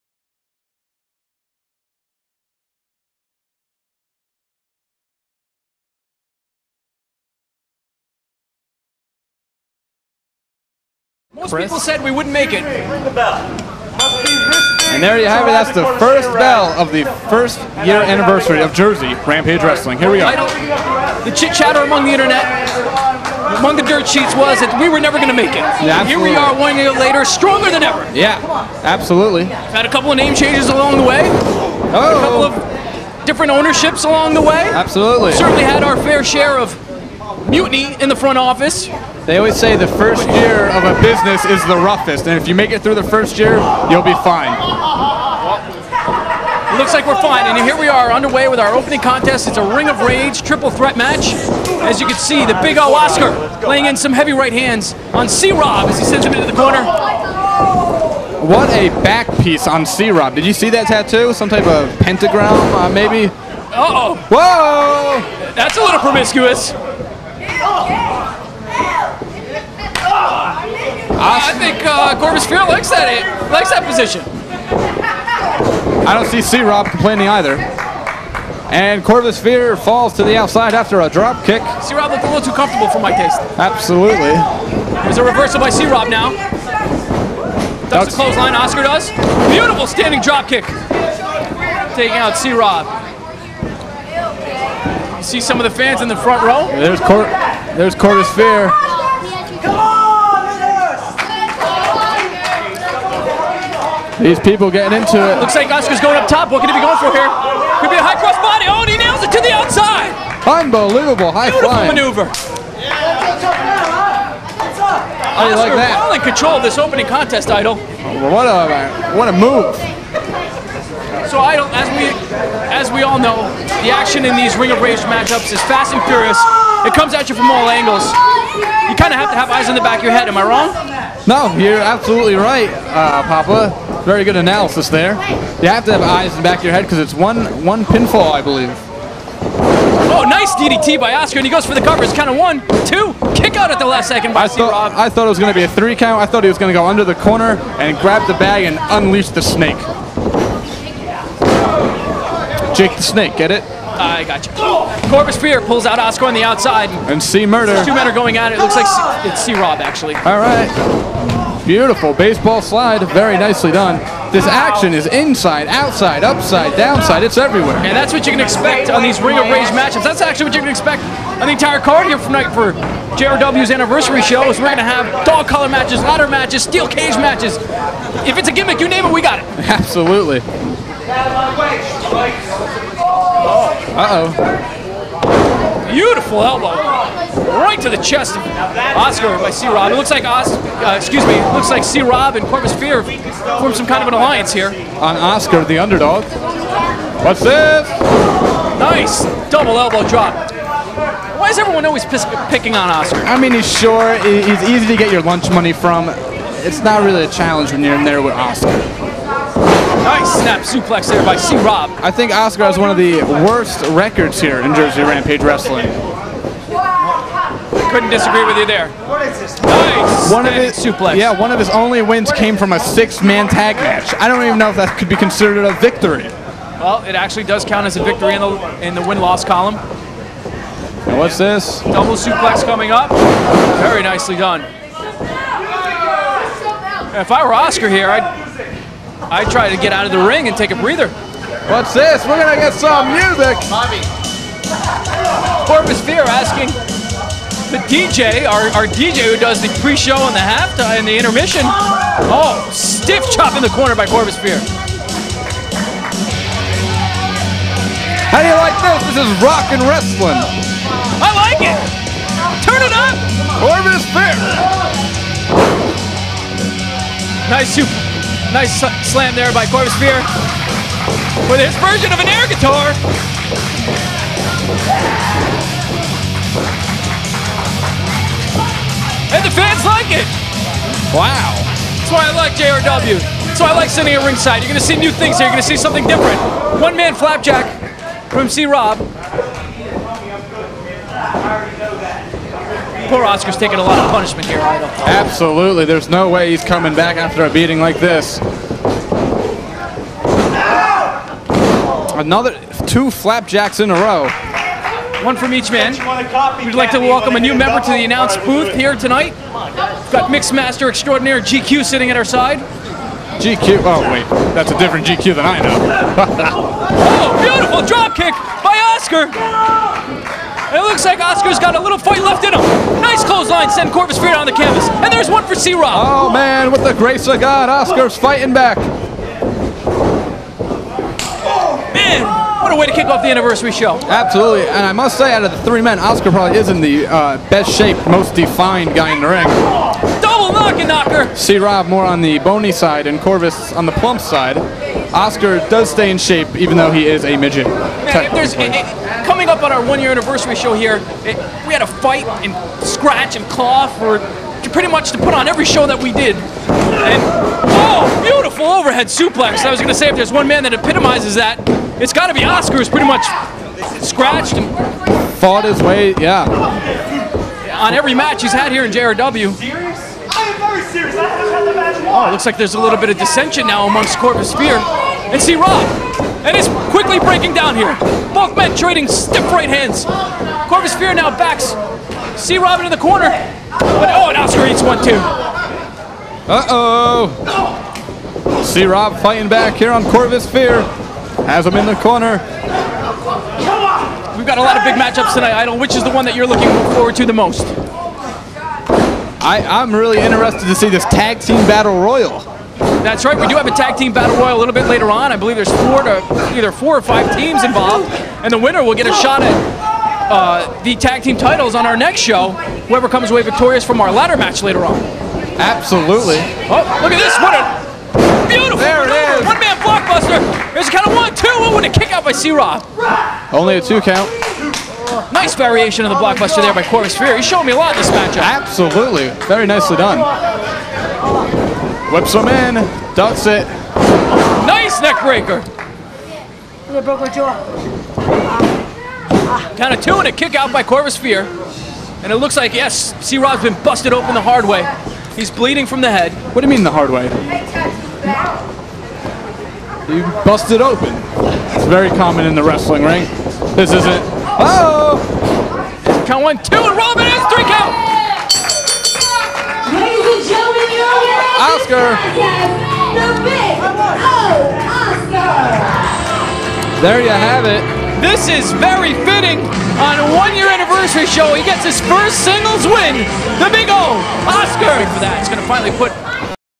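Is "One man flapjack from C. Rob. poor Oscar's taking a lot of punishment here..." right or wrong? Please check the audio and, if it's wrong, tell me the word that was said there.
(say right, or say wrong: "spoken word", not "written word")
right.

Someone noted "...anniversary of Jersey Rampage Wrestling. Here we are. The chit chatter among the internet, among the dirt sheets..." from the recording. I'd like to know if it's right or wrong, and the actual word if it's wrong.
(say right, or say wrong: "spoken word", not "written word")
right.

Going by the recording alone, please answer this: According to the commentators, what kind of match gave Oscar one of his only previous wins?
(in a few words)
Six-man tag match.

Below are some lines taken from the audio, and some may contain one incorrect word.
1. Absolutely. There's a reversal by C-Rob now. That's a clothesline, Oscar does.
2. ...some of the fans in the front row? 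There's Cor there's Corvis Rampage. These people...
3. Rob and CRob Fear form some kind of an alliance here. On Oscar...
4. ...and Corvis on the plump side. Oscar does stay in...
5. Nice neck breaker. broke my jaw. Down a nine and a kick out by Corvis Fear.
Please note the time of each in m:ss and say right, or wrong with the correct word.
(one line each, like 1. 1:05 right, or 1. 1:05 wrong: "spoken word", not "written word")
1. 1:23 right
2. 1:35 wrong: "Fear", not "Rampage"
3. 3:12 wrong: "Corvis", not "CRob"
4. 5:43 right
5. 7:14 wrong: "two", not "nine".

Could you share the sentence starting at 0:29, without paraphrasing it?
We've had a couple of name changes along the way.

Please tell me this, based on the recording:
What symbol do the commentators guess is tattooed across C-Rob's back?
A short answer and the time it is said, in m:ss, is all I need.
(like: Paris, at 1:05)
Pentagram, at 1:01.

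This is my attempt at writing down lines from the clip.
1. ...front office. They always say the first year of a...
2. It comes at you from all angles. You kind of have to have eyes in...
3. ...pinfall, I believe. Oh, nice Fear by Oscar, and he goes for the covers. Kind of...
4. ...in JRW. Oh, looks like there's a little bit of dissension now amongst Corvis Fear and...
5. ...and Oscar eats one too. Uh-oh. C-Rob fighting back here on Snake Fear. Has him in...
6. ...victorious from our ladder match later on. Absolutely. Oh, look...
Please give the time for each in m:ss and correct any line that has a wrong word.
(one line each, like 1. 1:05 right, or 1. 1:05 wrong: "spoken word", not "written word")
1. 0:38 right
2. 2:06 right
3. 2:17 wrong: "DDT", not "Fear"
4. 6:08 right
5. 6:24 wrong: "Corvis", not "Snake"
6. 6:53 right.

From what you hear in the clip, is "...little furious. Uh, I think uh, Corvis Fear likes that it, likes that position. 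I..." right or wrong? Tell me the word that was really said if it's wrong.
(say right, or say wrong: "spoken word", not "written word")
wrong: "promiscuous", not "furious".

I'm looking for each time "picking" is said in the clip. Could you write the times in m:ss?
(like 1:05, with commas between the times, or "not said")
3:22.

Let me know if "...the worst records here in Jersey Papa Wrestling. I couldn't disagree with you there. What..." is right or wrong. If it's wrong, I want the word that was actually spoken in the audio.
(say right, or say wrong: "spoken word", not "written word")
wrong: "Rampage", not "Papa".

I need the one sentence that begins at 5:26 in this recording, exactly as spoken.
Oh, man, with the grace of God, Oscar's fighting back.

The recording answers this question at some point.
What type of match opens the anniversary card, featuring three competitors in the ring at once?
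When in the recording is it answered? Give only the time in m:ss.
0:49.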